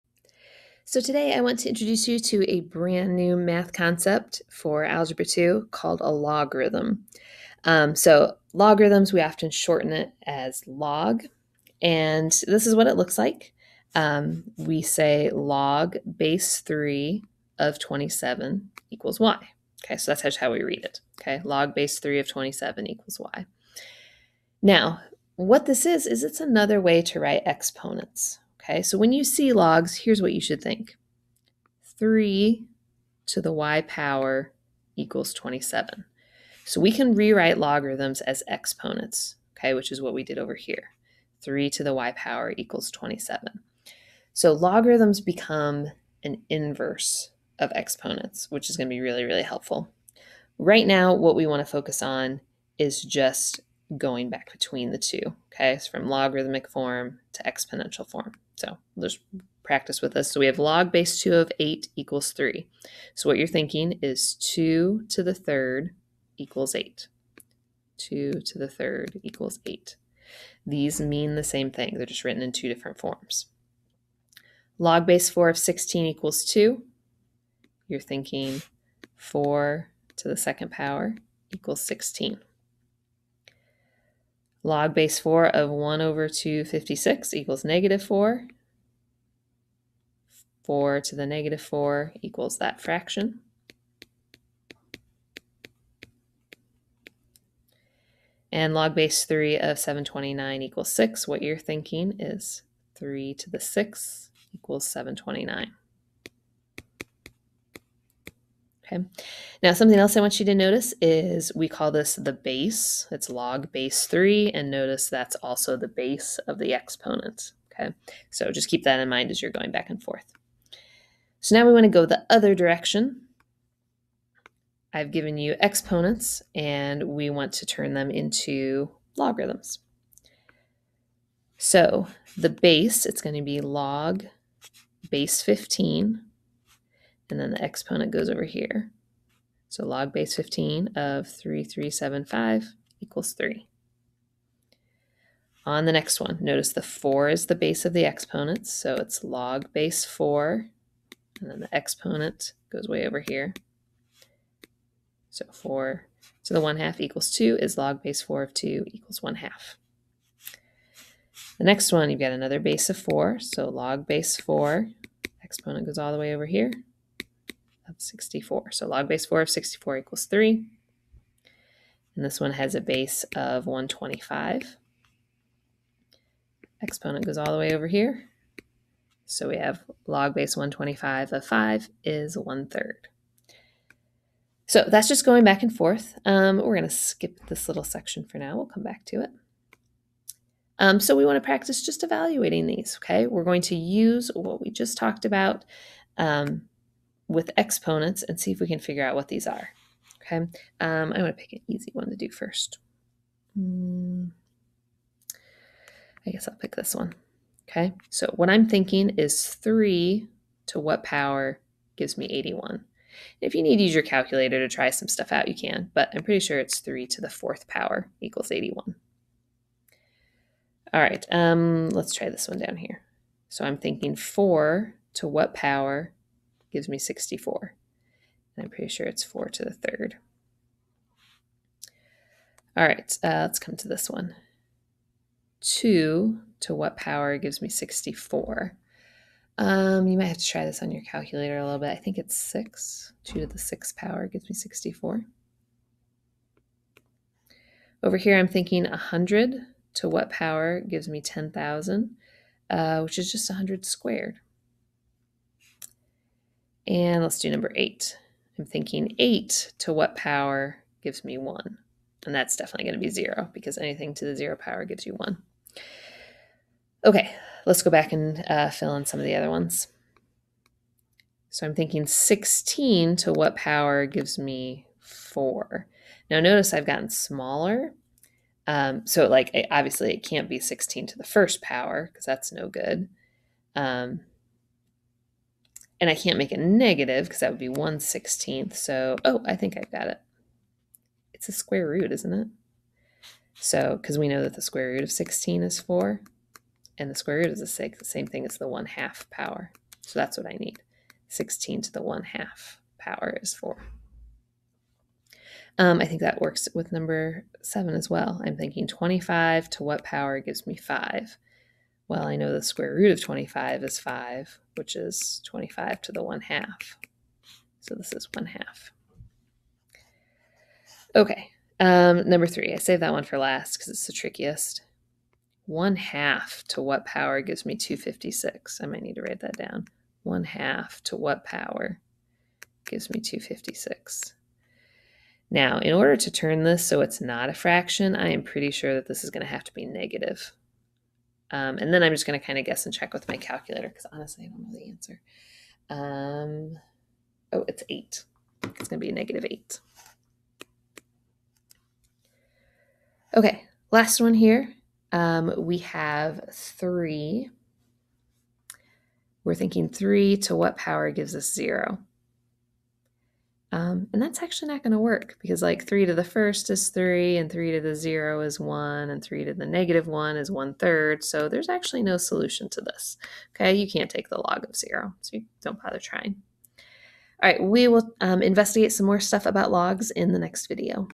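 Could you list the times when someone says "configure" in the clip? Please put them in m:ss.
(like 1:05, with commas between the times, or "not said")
not said.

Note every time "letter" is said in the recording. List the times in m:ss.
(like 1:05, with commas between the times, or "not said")
not said.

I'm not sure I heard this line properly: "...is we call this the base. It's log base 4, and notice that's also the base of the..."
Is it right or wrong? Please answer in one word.
wrong.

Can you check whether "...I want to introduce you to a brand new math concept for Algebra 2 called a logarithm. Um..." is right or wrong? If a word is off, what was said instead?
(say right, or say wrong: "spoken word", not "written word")
right.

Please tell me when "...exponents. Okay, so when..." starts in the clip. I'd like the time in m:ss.
0:27.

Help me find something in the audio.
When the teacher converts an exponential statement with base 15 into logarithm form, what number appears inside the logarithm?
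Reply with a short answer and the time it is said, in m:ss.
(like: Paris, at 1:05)
3375, at 2:21.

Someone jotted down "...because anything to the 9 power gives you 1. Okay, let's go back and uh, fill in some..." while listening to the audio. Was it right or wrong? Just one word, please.
wrong.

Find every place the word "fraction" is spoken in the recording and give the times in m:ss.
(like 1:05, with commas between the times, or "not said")
1:32, 5:37.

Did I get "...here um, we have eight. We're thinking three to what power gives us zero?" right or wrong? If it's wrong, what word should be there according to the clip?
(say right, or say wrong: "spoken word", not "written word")
wrong: "three", not "eight".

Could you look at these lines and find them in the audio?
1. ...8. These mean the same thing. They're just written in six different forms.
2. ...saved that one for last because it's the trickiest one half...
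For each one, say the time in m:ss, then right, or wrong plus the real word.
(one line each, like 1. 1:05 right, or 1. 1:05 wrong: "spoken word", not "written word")
1. 1:09 wrong: "two", not "six"
2. 5:22 right.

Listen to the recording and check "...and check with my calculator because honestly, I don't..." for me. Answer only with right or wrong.
right.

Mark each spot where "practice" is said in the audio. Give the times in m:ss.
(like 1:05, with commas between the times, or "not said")
0:59, 3:11.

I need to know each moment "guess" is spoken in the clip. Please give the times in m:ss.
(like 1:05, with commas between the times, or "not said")
3:26, 5:42.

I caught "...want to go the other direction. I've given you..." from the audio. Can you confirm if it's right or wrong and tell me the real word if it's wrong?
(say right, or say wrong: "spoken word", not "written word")
right.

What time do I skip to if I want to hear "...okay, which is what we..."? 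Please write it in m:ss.
0:39.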